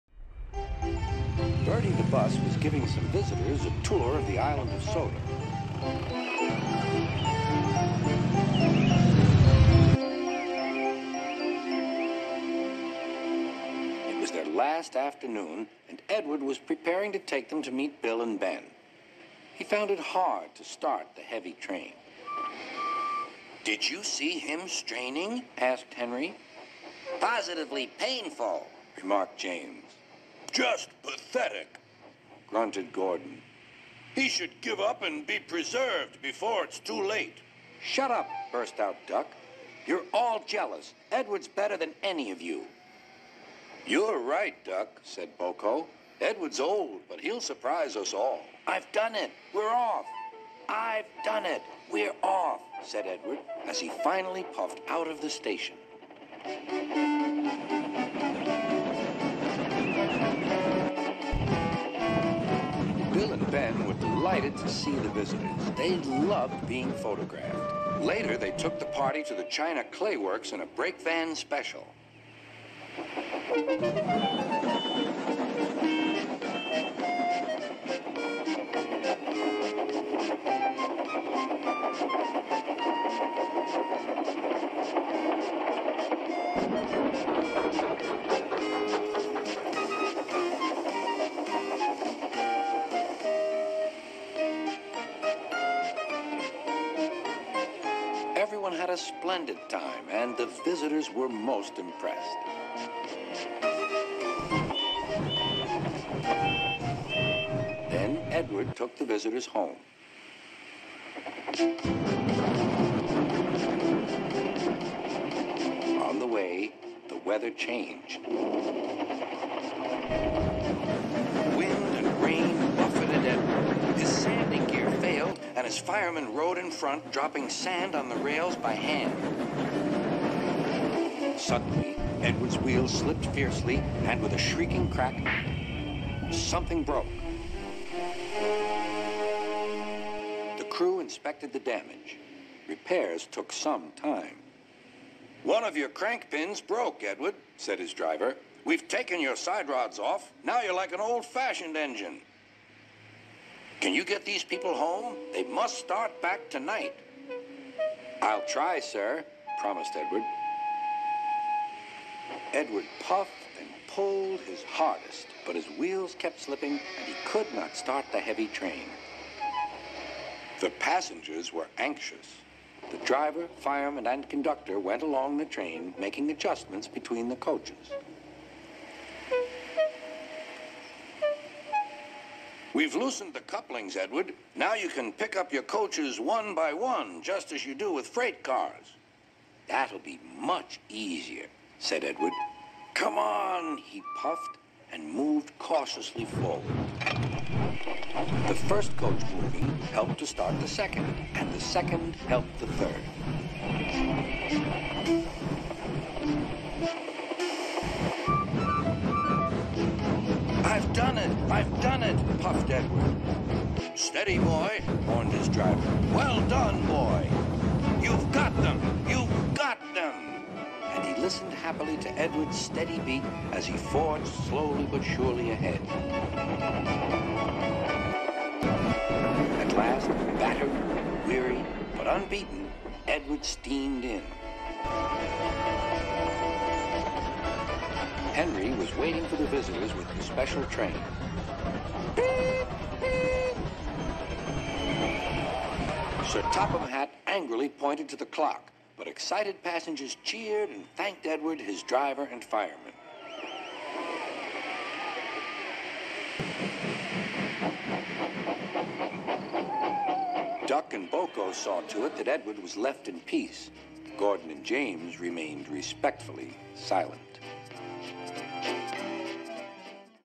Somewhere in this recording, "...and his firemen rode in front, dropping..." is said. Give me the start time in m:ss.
2:05.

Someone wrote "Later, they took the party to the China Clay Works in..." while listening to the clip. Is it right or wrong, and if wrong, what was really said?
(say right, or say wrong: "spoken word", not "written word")
right.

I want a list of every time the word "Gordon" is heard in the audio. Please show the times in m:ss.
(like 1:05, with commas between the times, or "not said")
0:32, 4:24.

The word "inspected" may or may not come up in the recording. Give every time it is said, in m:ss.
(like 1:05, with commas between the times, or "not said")
2:20.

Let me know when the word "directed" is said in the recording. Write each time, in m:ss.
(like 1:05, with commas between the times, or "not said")
not said.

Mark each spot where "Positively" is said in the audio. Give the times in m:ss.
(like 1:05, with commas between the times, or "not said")
0:27.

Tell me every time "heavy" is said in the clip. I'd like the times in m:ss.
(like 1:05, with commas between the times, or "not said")
0:21, 2:48.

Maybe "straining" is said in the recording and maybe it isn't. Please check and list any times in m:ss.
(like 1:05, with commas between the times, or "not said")
0:24.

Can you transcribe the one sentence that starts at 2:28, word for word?
We've taken your side rods off.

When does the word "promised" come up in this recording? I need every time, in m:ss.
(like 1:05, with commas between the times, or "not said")
2:39.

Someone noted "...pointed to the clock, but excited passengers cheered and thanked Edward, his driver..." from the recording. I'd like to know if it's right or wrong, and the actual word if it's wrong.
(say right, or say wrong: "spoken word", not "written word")
right.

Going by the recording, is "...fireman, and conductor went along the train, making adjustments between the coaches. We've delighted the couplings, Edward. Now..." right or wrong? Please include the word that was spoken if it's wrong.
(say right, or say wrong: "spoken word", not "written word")
wrong: "loosened", not "delighted".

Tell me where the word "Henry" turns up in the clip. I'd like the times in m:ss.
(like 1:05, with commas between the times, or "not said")
0:25, 3:58.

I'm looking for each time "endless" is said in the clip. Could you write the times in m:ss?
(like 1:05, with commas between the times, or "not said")
not said.